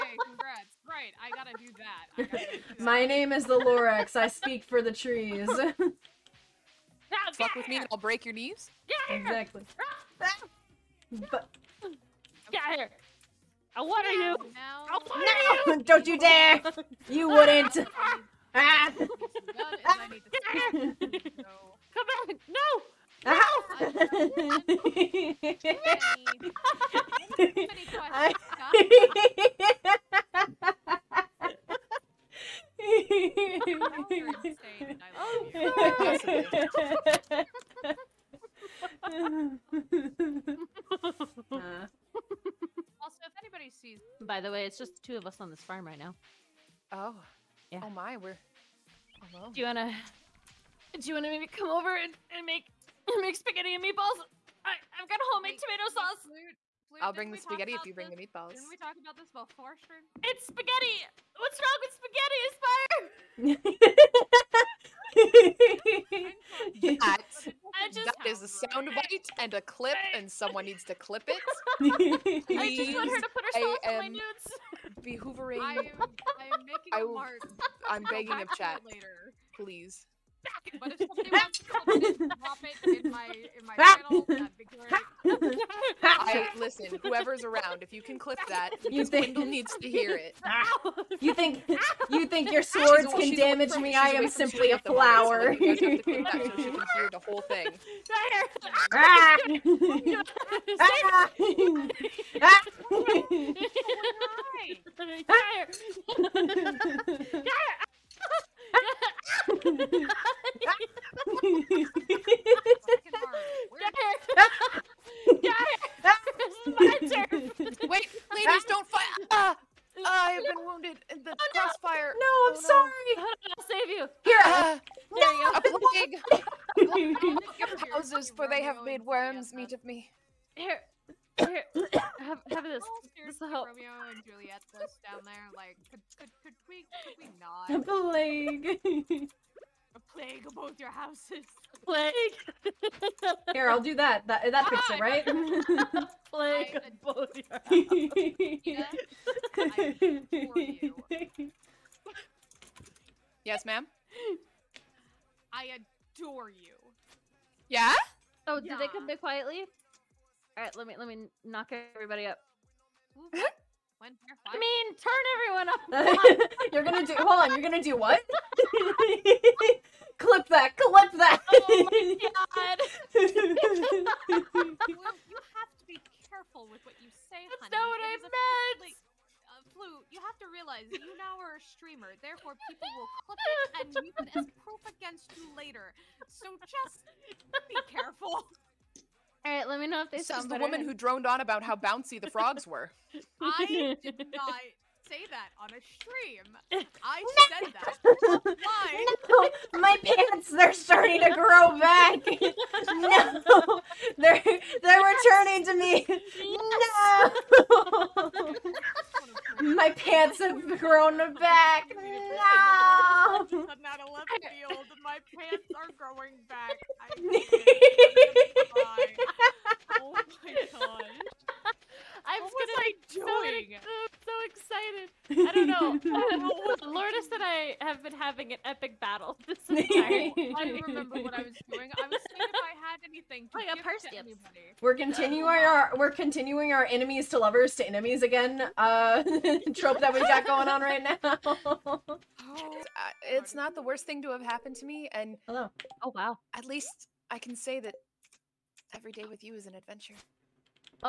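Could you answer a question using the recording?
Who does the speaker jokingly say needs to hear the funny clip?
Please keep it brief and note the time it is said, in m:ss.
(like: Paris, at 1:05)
Wendell, at 1:29.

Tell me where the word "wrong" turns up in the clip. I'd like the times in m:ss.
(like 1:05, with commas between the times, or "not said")
1:03.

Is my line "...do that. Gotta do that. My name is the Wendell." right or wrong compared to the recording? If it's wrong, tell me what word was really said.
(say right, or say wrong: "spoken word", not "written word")
wrong: "Lorax", not "Wendell".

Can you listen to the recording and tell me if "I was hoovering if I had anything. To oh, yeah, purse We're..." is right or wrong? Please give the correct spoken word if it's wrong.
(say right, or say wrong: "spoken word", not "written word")
wrong: "seeing", not "hoovering".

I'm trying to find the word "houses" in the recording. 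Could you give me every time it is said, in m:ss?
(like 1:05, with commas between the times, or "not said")
2:07, 2:20, 2:29.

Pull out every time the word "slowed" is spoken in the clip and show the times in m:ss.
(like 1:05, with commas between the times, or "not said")
not said.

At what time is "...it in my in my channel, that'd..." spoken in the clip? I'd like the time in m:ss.
1:22.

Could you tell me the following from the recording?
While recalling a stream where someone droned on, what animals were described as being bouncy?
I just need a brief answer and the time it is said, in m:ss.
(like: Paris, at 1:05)
frogs, at 3:12.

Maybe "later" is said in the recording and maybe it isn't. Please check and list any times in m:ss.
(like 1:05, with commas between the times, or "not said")
1:18, 3:05.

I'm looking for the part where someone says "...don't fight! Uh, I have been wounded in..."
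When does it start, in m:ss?
1:58.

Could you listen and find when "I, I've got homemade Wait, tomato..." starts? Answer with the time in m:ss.
0:54.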